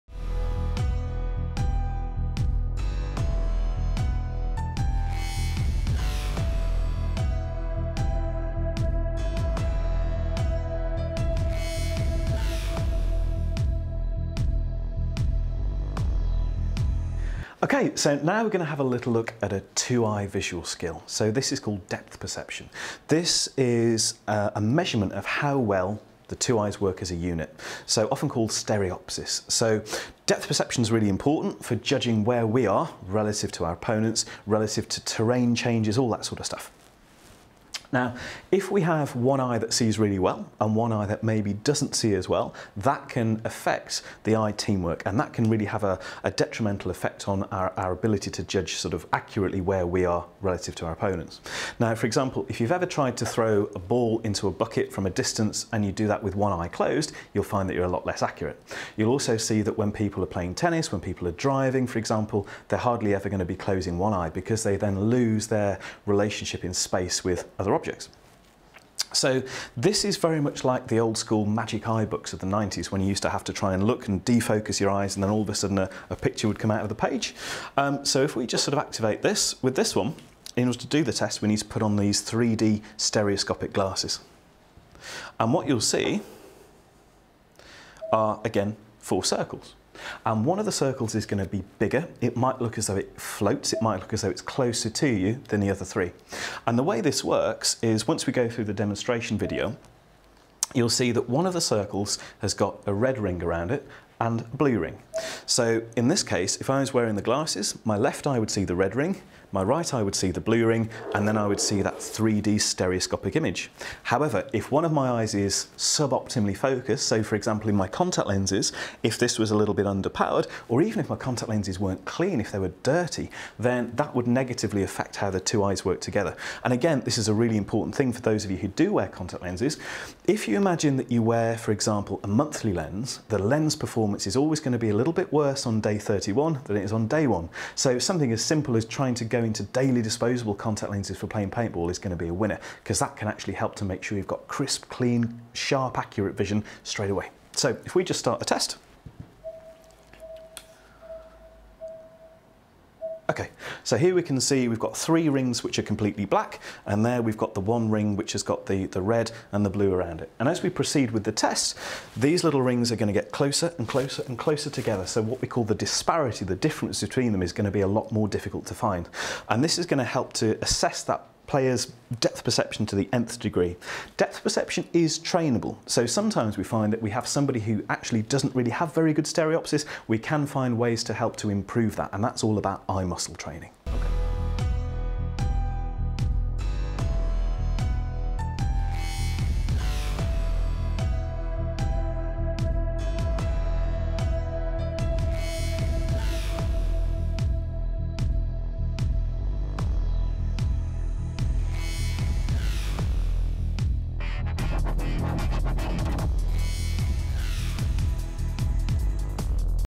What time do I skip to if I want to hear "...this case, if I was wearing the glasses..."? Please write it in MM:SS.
01:46.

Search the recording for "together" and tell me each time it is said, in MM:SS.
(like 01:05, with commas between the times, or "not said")
02:05, 02:44.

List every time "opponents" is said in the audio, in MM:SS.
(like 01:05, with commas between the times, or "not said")
00:33, 00:50.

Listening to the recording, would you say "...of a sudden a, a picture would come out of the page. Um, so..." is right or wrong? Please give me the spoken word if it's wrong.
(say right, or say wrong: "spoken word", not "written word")
right.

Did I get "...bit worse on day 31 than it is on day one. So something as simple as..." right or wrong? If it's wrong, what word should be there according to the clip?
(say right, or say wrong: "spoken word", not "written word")
right.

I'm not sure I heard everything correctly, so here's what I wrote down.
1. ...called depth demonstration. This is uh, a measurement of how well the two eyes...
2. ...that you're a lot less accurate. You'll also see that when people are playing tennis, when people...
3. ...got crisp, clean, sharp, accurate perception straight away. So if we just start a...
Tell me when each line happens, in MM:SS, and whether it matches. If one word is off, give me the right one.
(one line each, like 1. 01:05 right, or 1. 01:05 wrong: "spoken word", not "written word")
1. 00:21 wrong: "perception", not "demonstration"
2. 00:57 right
3. 02:24 wrong: "vision", not "perception".